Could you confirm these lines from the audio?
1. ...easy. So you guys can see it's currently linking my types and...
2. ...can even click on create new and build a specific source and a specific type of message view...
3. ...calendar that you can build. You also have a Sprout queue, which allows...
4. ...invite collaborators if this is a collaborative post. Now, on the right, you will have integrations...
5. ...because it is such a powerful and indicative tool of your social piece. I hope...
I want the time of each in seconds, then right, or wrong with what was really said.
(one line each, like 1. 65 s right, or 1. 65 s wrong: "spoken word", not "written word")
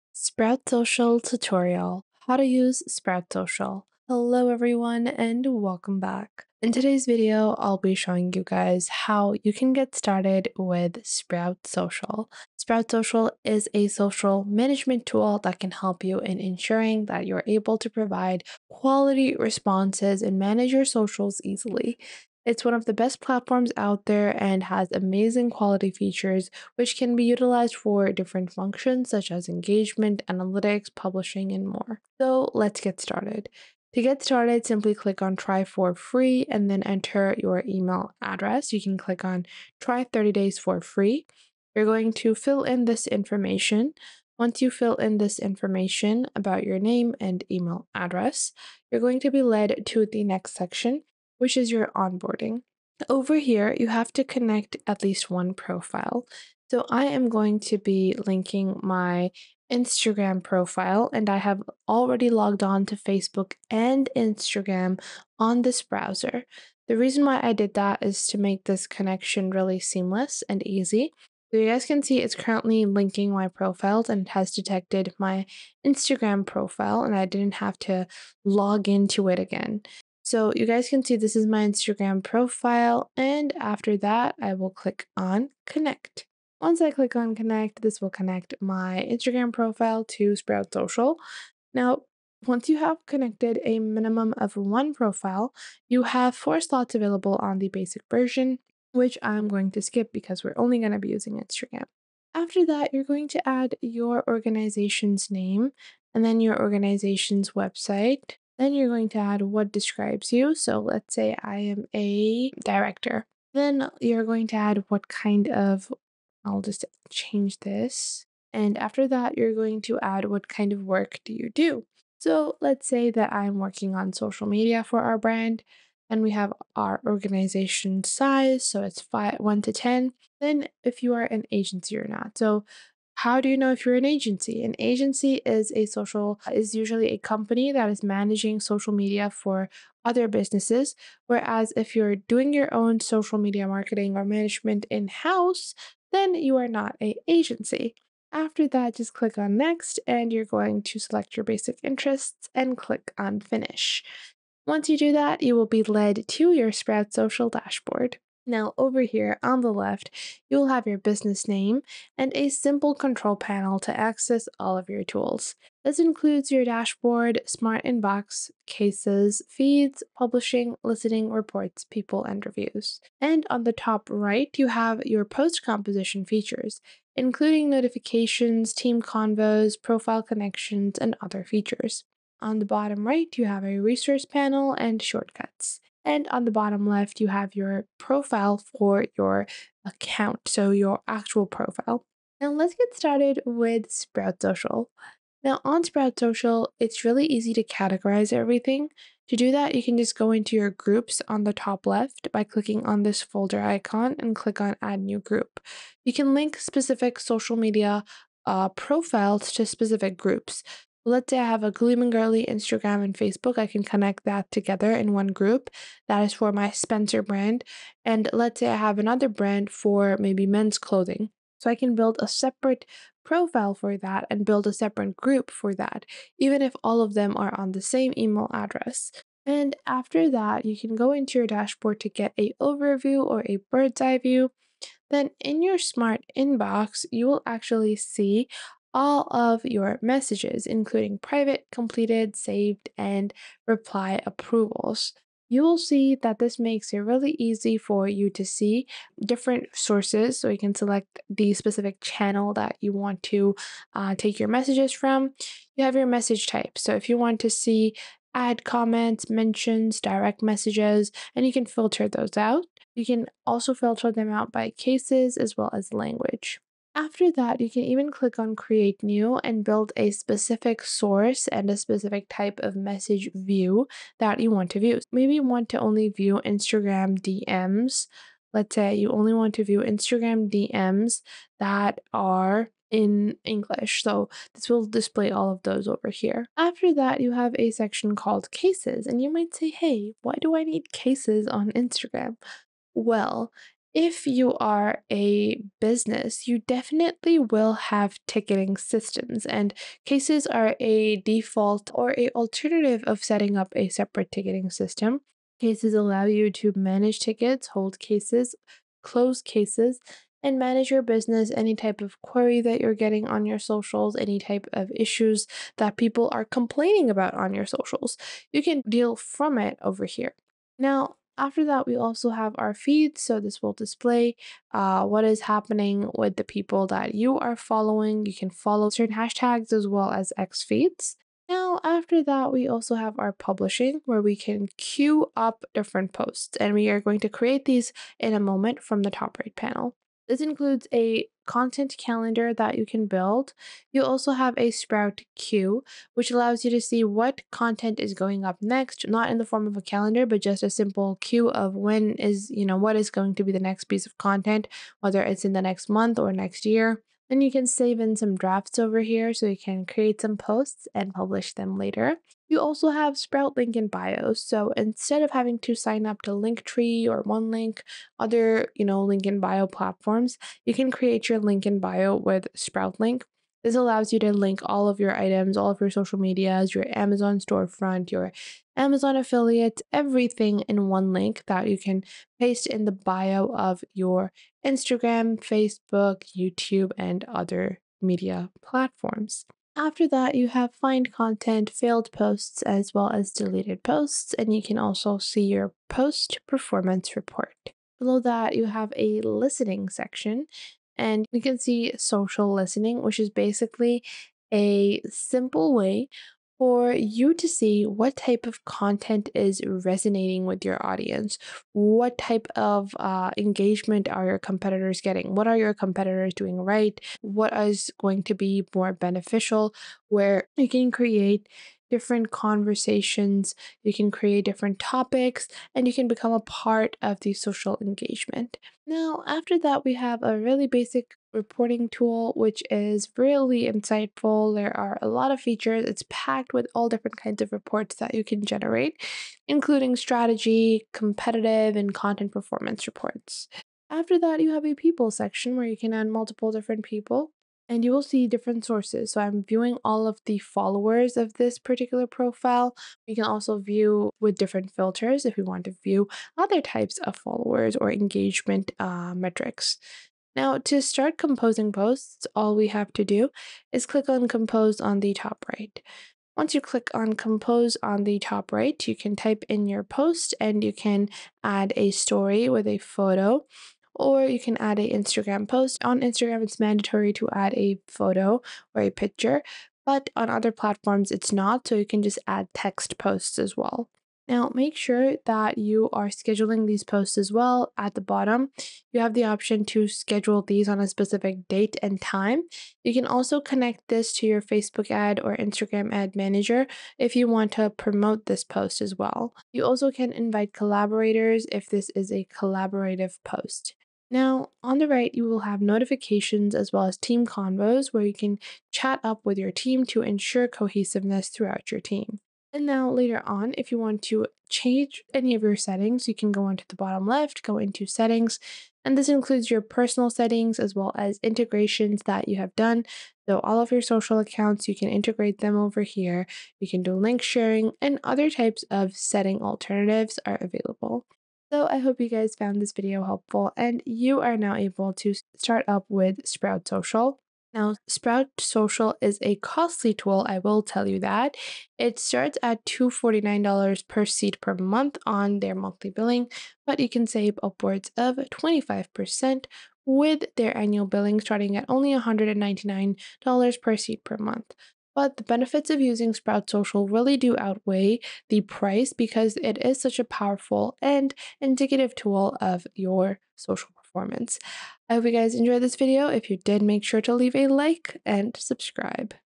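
1. 70 s wrong: "profiles", not "types"
2. 267 s right
3. 341 s right
4. 500 s wrong: "notifications", not "integrations"
5. 558 s wrong: "performance", not "piece".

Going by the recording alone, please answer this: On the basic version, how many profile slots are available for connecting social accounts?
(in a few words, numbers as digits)
4.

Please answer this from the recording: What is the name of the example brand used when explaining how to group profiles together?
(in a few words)
Gleam and Girly.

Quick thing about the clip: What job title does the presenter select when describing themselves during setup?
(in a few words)
director.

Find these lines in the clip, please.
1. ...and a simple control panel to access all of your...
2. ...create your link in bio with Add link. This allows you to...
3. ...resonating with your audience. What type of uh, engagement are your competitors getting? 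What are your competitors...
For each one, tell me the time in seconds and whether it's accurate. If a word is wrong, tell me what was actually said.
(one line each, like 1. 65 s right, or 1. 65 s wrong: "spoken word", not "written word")
1. 162 s right
2. 370 s wrong: "Sprout", not "Add"
3. 409 s right.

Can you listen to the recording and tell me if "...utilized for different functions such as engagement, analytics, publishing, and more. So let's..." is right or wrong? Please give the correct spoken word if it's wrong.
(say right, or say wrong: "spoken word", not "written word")
right.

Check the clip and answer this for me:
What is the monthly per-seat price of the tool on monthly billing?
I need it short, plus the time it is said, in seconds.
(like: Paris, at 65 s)
$249, at 542 s.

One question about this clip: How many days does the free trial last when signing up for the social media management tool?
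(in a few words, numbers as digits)
30.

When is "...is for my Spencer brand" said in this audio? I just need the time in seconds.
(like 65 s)
216 s.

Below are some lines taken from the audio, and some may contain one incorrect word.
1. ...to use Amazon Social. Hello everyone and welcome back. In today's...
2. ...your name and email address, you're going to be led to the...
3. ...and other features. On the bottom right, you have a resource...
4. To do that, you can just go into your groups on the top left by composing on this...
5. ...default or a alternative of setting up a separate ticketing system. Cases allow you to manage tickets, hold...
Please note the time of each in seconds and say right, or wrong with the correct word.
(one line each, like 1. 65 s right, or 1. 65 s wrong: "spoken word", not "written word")
1. 2 s wrong: "Sprout", not "Amazon"
2. 46 s right
3. 180 s right
4. 199 s wrong: "clicking", not "composing"
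5. 301 s right.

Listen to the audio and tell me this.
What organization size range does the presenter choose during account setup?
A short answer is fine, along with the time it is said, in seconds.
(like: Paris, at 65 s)
1 to 10, at 129 s.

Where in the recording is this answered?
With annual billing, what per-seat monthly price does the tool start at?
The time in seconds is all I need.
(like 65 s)
551 s.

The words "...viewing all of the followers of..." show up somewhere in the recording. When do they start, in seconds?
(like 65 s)
449 s.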